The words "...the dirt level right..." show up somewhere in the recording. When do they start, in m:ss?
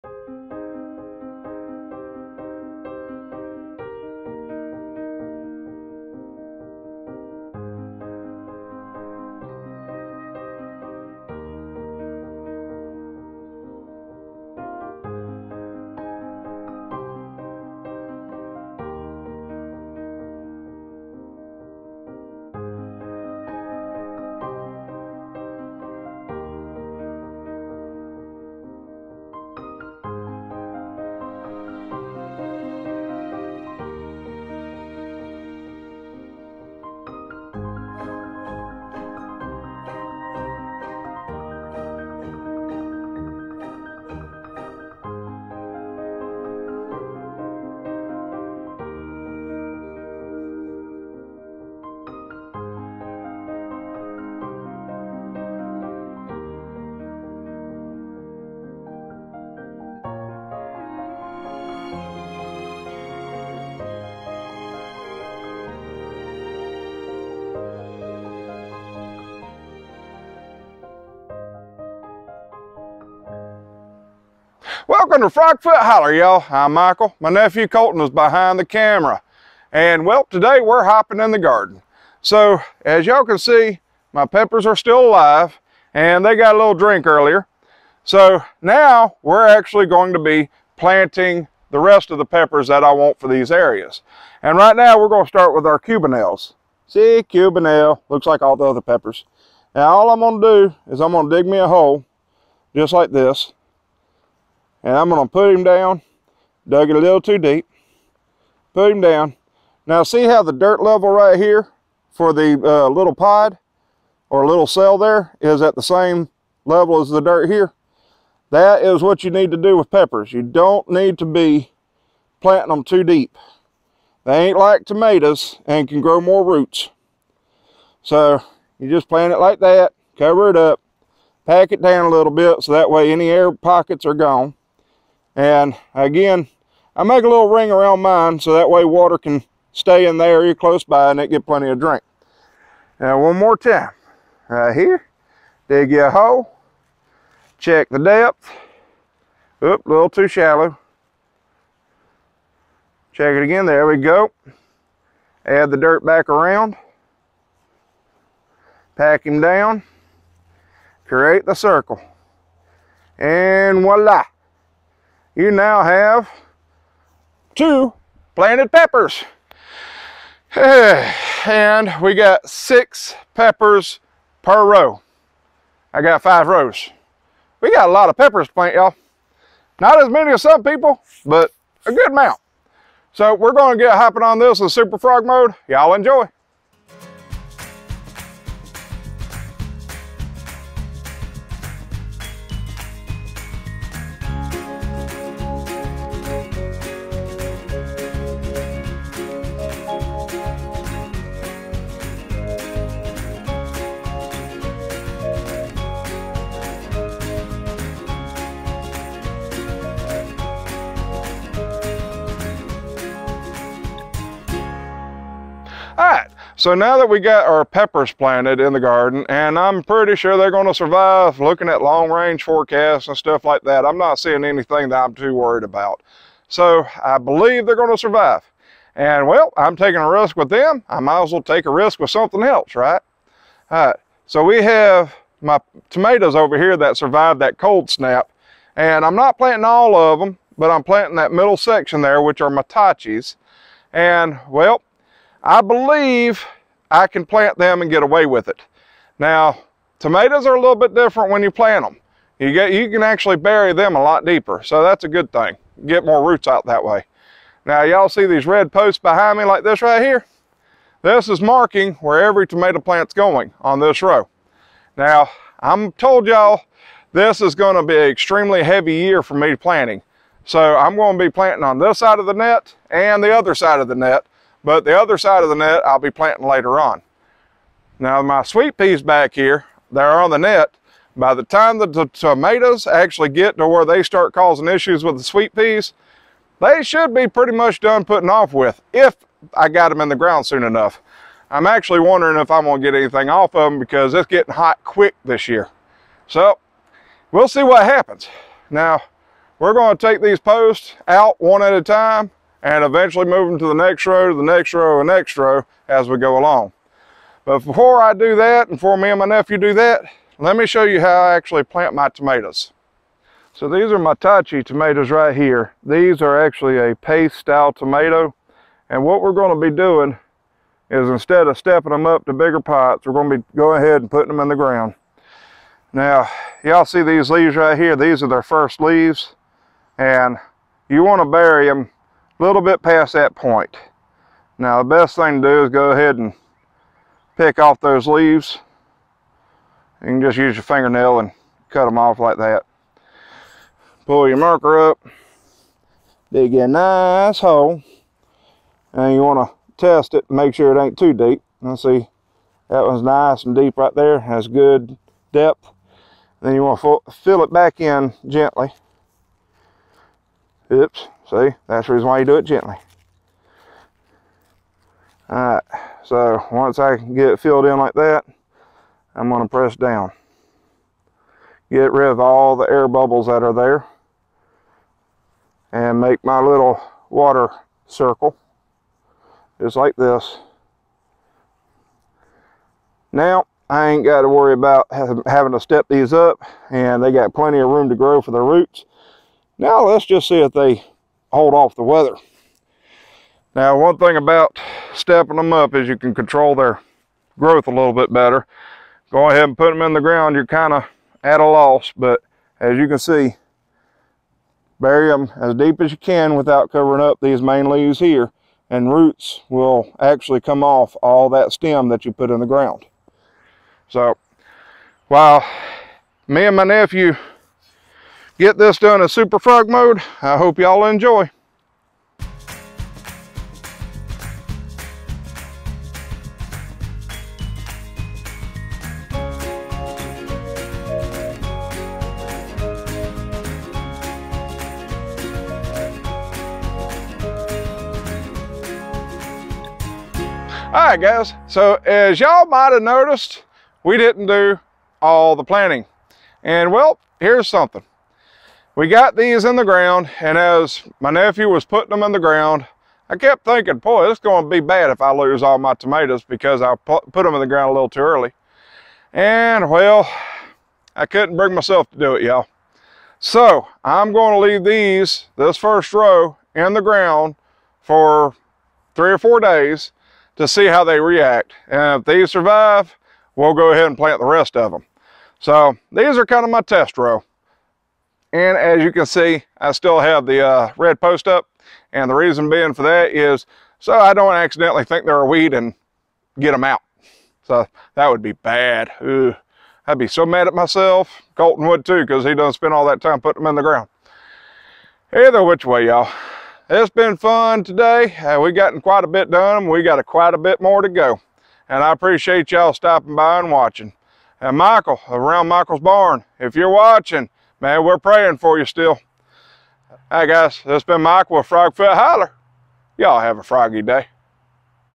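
1:50.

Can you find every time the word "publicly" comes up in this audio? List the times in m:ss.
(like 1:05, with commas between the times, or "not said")
not said.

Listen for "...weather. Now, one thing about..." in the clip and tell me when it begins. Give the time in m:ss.
6:31.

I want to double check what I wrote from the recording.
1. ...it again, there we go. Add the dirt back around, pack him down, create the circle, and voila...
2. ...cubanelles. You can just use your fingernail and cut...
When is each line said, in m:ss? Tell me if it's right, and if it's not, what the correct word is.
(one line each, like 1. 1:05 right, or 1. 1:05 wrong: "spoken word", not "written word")
1. 2:33 right
2. 5:38 wrong: "leaves", not "cubanelles".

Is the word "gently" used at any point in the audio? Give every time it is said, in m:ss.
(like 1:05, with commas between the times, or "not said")
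5:58, 6:02.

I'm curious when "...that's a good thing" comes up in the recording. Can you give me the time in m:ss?
4:14.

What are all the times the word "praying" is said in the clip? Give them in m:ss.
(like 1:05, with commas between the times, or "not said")
8:27.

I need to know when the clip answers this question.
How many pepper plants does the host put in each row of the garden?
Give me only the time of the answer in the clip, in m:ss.
2:52.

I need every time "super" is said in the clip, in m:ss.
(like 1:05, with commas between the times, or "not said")
3:04, 6:59.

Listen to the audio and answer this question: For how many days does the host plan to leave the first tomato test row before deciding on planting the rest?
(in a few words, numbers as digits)
3 or 4.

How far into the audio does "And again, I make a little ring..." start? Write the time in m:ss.
2:15.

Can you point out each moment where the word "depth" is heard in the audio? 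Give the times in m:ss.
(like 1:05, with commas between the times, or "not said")
2:27, 5:55.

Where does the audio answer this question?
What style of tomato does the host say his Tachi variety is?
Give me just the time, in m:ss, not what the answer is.
5:16.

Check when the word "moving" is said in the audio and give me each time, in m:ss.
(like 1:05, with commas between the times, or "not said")
5:03.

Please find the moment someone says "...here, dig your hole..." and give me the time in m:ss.
2:24.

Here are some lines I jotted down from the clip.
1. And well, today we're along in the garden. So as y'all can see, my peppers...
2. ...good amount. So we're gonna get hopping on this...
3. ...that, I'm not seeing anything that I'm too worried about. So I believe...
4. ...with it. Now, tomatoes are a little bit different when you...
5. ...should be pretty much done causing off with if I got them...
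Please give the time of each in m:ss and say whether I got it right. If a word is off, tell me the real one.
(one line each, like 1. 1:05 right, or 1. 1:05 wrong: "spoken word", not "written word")
1. 1:19 wrong: "hopping", not "along"
2. 3:01 right
3. 3:43 right
4. 4:08 right
5. 4:46 wrong: "putting", not "causing".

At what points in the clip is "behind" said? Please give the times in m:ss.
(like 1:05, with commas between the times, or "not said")
1:18, 4:18.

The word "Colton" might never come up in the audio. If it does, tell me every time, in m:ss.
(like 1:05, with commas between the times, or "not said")
1:17, 8:11.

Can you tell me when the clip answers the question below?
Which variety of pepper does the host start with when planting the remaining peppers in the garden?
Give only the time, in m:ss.
1:35.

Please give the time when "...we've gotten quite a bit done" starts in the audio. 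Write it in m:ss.
8:18.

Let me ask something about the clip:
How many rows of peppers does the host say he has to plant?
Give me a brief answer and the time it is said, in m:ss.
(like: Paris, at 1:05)
5, at 2:56.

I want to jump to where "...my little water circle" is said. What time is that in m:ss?
6:16.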